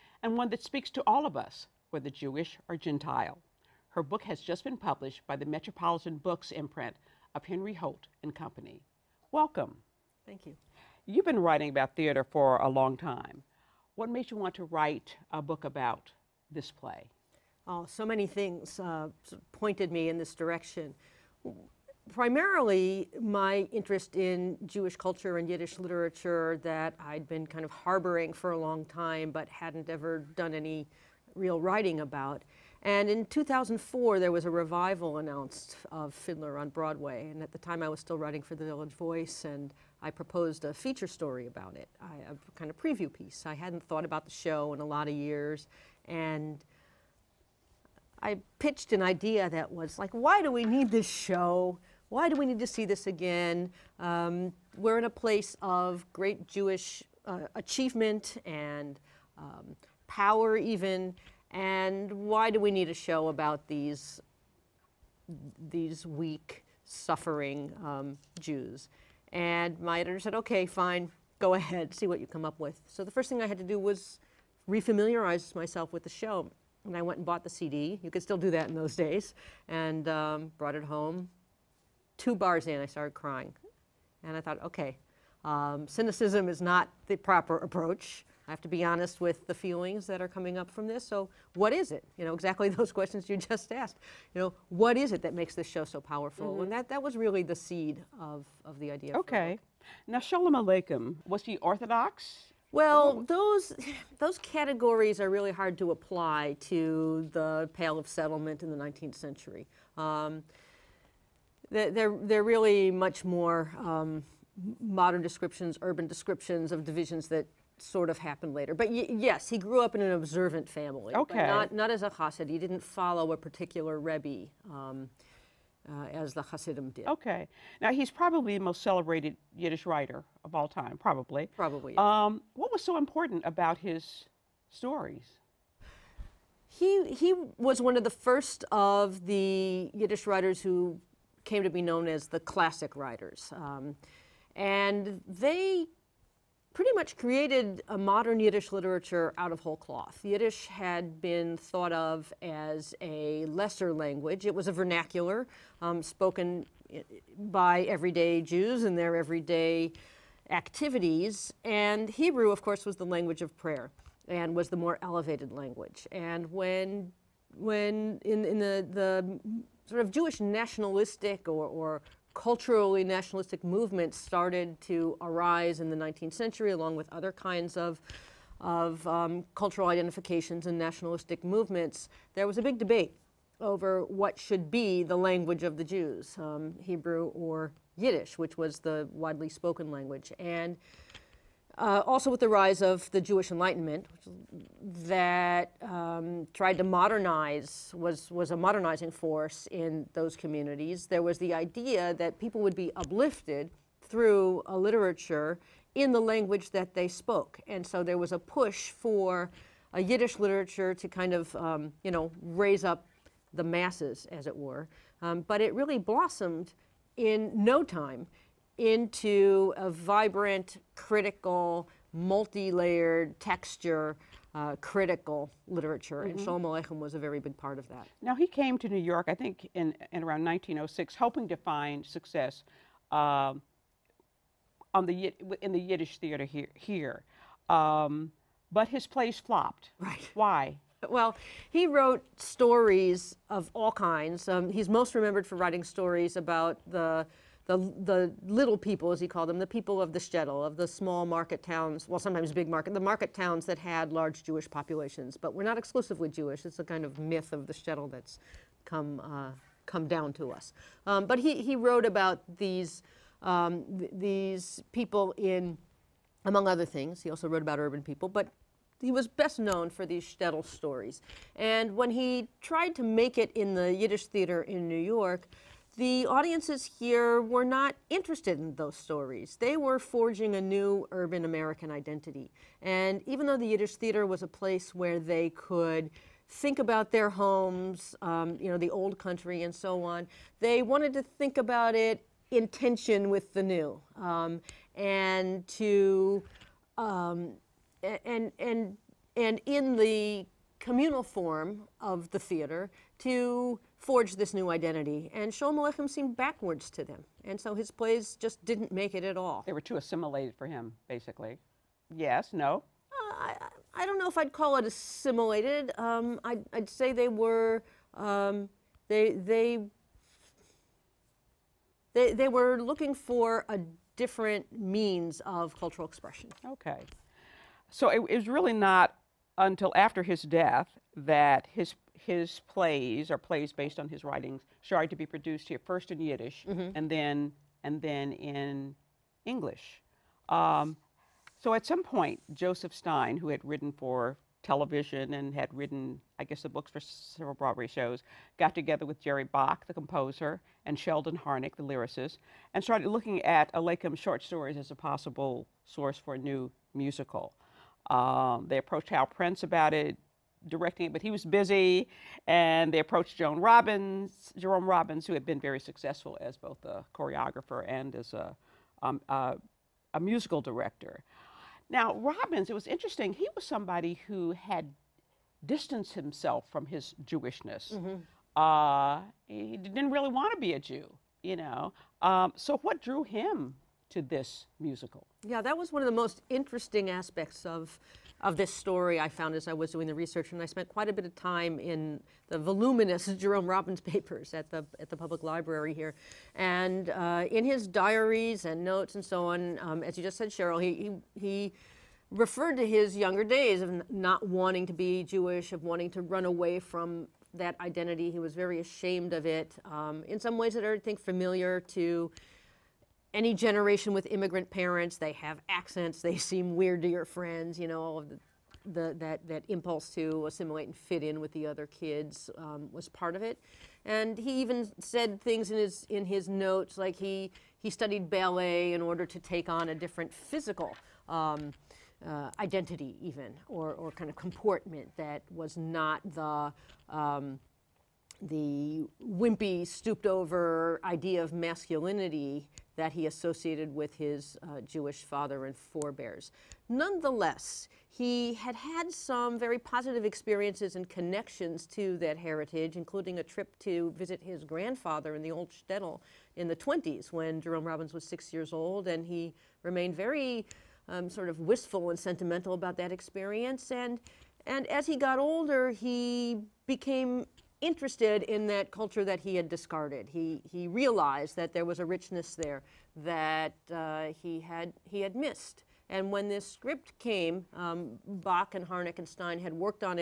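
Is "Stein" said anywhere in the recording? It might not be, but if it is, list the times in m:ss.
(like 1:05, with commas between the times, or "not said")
5:42, 7:59.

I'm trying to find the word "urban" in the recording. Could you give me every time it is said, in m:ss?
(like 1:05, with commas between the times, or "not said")
1:55, 4:27, 4:41.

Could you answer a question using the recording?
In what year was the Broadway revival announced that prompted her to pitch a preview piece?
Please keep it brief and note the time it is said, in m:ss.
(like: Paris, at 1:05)
2004, at 0:33.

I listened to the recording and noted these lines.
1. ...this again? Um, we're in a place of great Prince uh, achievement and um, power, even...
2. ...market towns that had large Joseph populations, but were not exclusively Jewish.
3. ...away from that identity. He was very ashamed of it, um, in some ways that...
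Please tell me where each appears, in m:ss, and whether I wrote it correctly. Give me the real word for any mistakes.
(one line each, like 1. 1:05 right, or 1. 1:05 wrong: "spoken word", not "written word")
1. 0:52 wrong: "Jewish", not "Prince"
2. 4:12 wrong: "Jewish", not "Joseph"
3. 6:46 right.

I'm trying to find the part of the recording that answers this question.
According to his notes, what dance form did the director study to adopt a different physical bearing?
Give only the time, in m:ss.
7:08.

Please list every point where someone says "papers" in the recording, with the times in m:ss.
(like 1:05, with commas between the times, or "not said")
6:34.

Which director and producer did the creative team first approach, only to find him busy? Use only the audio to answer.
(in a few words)
Hal Prince.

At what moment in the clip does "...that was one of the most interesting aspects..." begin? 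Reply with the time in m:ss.
6:25.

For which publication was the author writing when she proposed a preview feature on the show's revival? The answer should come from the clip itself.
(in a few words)
Village Voice.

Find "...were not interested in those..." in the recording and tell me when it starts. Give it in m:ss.
4:37.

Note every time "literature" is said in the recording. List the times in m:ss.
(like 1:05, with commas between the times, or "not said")
0:25, 2:28, 3:24, 3:30, 3:45.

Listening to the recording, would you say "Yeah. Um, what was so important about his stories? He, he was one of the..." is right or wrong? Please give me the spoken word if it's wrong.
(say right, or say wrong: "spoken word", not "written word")
right.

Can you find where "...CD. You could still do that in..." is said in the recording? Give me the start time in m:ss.
1:17.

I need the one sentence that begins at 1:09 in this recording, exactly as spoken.
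And my editor said, okay, fine, go ahead, see what you come up with.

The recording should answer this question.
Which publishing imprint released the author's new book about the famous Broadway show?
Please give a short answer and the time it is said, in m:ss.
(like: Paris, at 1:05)
Metropolitan Books, at 0:05.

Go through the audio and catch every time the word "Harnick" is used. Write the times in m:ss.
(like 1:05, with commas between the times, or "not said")
5:51, 7:58.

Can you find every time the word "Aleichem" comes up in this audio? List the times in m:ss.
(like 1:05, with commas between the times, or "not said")
1:40, 3:46, 5:05, 5:53.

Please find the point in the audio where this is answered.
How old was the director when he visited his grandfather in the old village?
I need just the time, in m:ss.
7:38.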